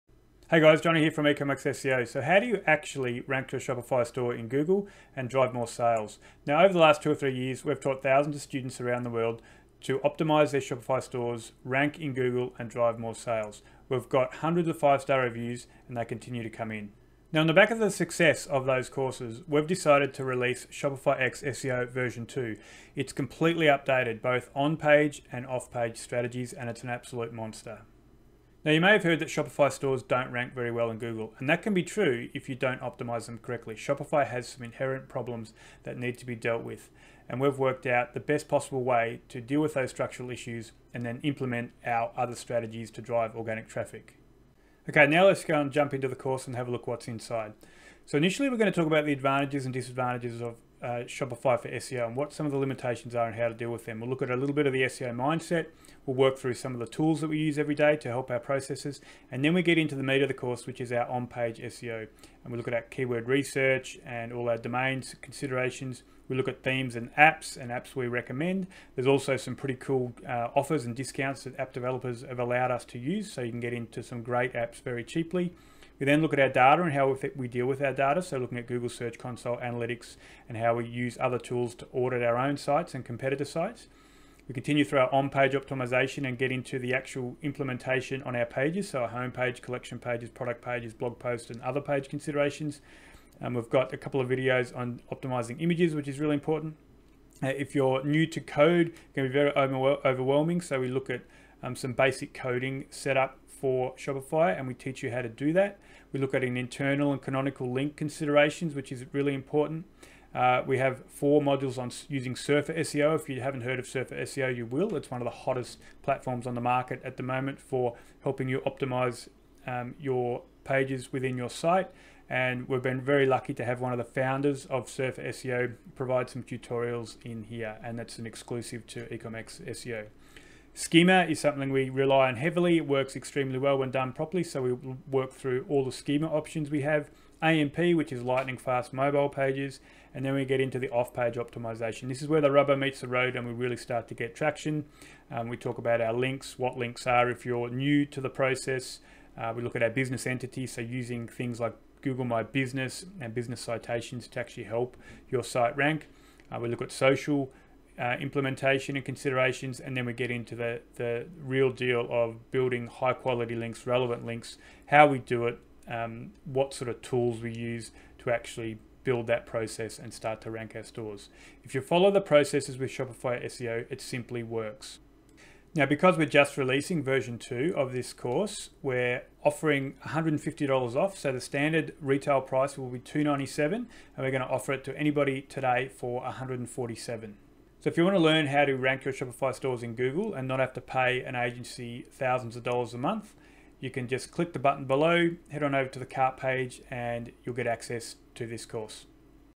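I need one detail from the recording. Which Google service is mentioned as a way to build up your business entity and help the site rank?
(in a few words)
Google My Business.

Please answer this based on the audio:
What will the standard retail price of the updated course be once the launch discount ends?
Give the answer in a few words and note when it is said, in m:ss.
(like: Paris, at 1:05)
$297, at 3:02.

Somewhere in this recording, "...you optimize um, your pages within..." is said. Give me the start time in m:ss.
1:58.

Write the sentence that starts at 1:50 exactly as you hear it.
Uh, we have four modules on using Surfer SEO.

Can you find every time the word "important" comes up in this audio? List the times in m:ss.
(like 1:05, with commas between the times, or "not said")
1:36, 1:49.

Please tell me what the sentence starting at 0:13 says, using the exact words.
We've got hundreds of five-star reviews and they continue to come in.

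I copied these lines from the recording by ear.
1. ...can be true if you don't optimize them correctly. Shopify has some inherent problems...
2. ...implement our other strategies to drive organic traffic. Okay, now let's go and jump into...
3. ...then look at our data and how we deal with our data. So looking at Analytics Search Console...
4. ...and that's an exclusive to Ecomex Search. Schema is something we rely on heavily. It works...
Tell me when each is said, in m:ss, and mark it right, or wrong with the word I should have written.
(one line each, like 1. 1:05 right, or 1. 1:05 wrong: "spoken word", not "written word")
1. 0:31 right
2. 0:41 right
3. 1:16 wrong: "Google", not "Analytics"
4. 2:07 wrong: "SEO", not "Search".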